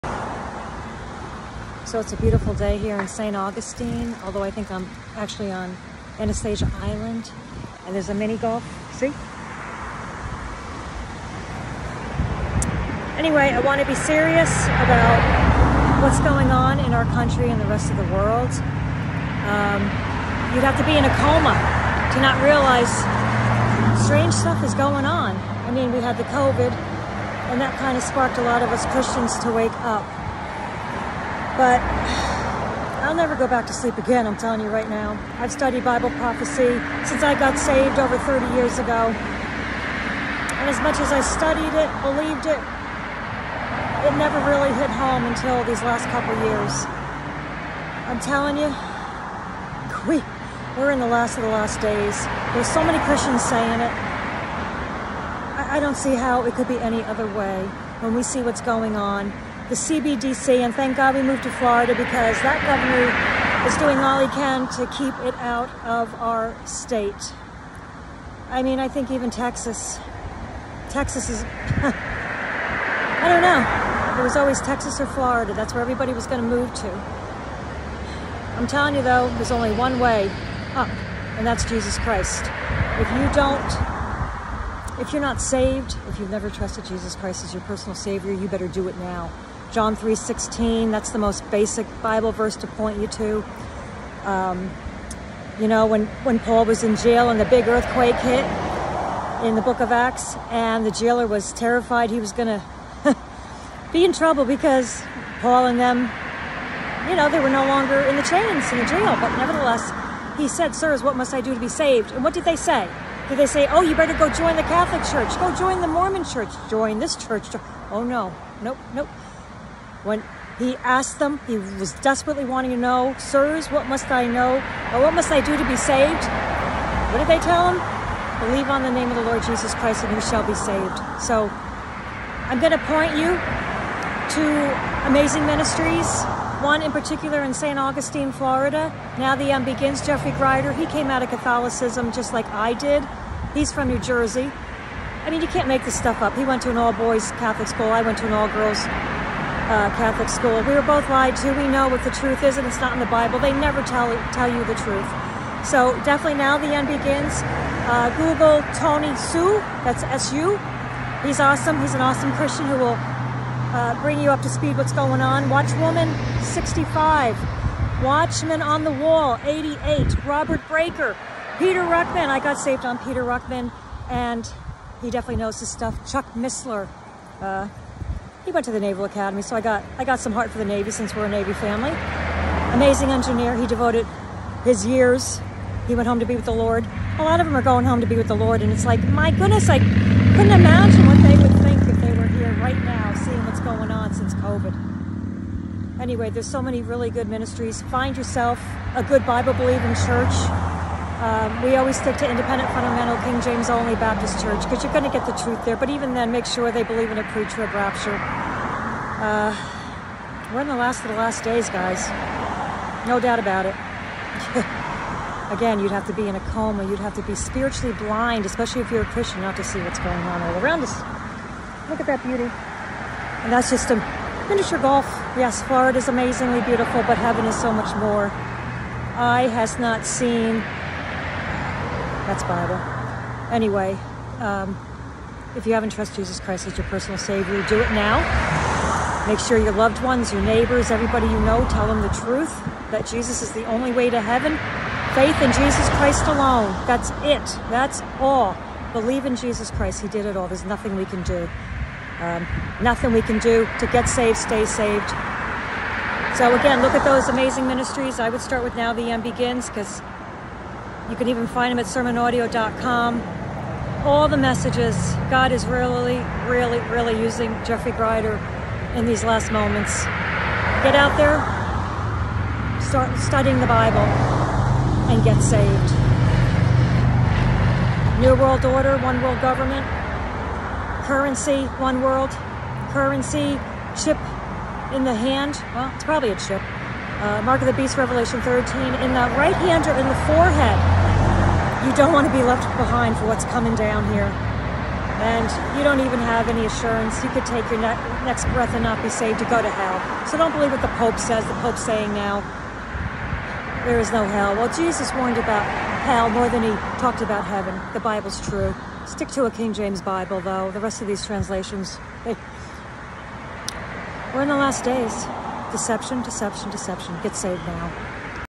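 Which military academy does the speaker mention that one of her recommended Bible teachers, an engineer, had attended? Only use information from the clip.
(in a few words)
Naval Academy.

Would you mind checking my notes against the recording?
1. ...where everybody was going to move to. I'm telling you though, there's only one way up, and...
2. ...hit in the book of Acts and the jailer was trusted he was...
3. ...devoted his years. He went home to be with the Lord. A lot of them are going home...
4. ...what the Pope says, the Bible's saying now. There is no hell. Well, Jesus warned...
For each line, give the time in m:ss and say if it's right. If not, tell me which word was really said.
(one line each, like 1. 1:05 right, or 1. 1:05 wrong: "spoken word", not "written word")
1. 1:15 right
2. 1:38 wrong: "terrified", not "trusted"
3. 3:03 right
4. 5:00 wrong: "Pope", not "Bible".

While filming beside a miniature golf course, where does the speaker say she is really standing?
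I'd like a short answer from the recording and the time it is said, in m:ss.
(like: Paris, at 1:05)
Anastasia Island, at 0:06.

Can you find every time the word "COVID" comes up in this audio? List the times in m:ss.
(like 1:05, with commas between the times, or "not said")
0:26, 3:14.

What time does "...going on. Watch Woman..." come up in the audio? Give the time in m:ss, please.
2:44.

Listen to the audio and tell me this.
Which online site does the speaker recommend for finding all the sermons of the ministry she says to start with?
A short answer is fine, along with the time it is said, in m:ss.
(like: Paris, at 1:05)
sermonaudio.com, at 4:21.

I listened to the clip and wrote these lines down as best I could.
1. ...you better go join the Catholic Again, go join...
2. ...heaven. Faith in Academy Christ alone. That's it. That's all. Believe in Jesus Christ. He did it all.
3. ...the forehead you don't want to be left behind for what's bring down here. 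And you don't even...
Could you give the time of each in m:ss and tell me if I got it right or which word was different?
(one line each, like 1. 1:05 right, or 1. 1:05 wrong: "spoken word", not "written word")
1. 1:53 wrong: "Church", not "Again"
2. 4:04 wrong: "Jesus", not "Academy"
3. 4:50 wrong: "coming", not "bring".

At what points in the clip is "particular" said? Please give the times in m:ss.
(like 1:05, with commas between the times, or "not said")
2:16.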